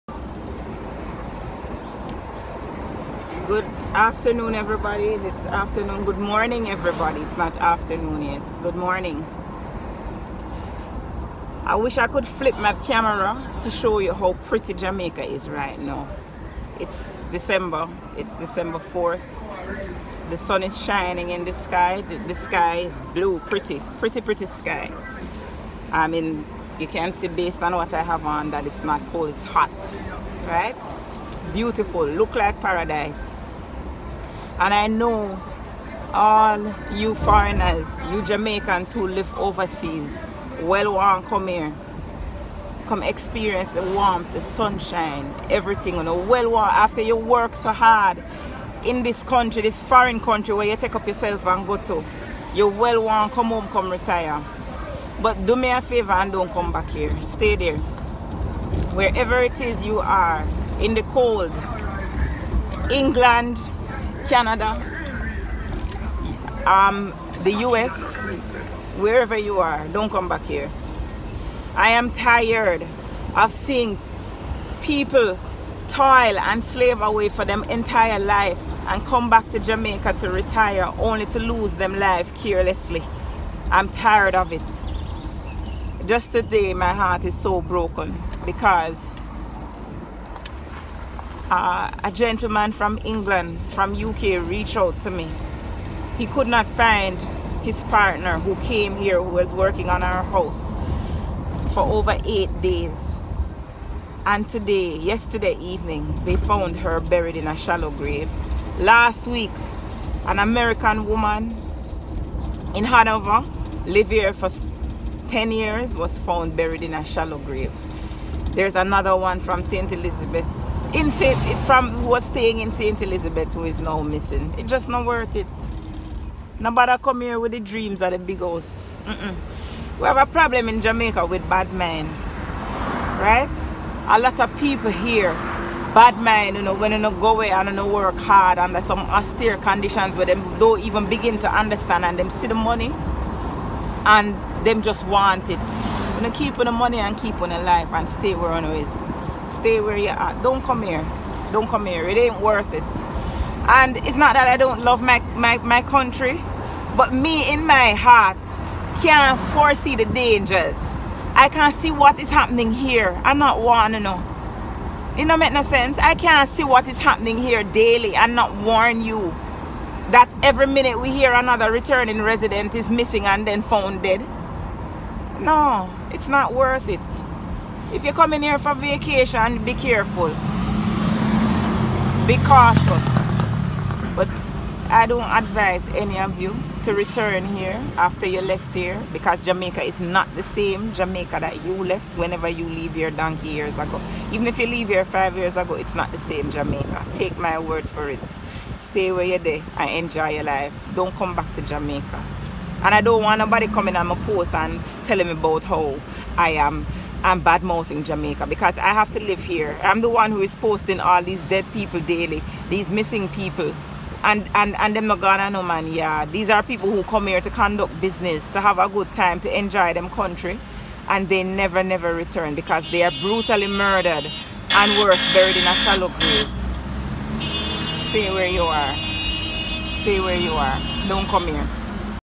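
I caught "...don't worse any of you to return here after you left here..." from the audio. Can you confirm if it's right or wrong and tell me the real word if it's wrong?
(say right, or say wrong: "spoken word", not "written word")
wrong: "advise", not "worse".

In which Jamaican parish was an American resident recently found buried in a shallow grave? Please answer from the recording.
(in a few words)
Hanover.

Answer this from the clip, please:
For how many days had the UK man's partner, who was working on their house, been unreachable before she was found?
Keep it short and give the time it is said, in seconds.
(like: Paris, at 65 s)
over 8 days, at 101 s.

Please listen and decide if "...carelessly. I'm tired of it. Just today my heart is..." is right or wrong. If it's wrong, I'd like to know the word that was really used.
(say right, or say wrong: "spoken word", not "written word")
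right.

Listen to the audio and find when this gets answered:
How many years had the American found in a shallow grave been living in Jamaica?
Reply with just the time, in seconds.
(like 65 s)
115 s.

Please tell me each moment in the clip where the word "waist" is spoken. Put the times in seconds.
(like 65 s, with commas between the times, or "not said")
not said.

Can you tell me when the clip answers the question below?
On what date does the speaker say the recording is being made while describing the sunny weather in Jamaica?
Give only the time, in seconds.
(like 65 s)
18 s.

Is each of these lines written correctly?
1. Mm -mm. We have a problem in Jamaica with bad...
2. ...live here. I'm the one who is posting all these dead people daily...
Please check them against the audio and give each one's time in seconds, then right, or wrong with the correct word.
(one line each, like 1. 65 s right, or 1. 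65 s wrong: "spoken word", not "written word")
1. 129 s right
2. 209 s right.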